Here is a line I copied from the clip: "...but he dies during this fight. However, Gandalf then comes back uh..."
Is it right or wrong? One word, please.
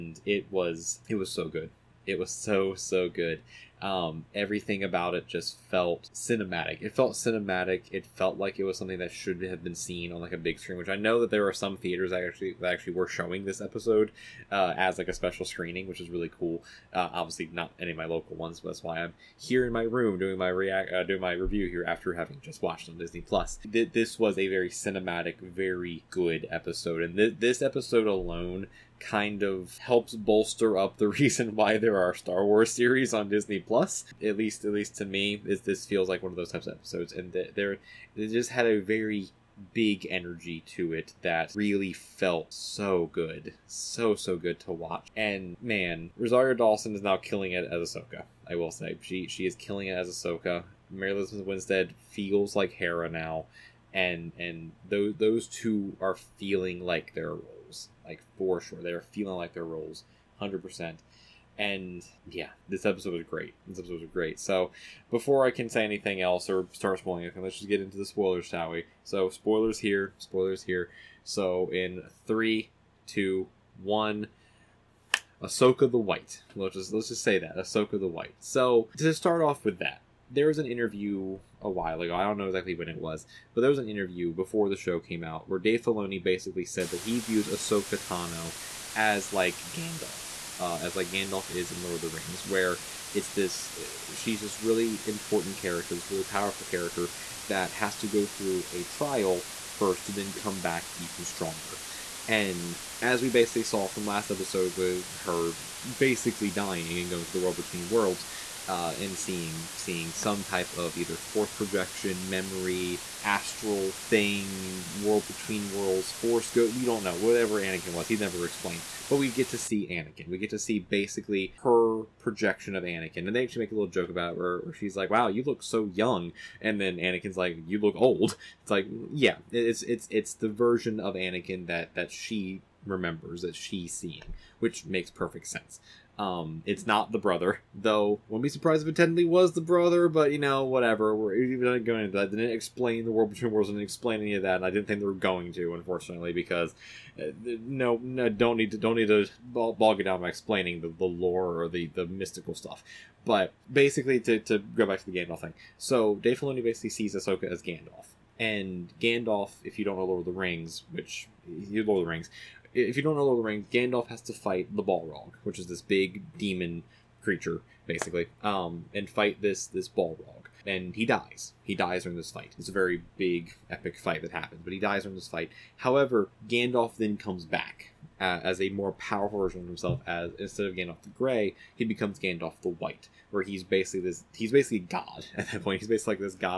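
right.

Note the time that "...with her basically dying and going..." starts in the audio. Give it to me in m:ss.
1:44.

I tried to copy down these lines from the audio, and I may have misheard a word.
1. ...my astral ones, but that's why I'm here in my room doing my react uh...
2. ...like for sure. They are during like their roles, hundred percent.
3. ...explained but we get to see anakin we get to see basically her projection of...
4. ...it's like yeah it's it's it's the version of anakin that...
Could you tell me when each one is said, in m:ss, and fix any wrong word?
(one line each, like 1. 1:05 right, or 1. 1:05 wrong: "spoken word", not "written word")
1. 0:17 wrong: "local", not "astral"
2. 0:58 wrong: "feeling", not "during"
3. 1:58 right
4. 2:08 right.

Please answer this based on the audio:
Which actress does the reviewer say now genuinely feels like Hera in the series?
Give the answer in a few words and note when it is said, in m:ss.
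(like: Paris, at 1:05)
Mary Elizabeth Winstead, at 0:50.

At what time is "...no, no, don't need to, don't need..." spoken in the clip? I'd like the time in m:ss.
2:27.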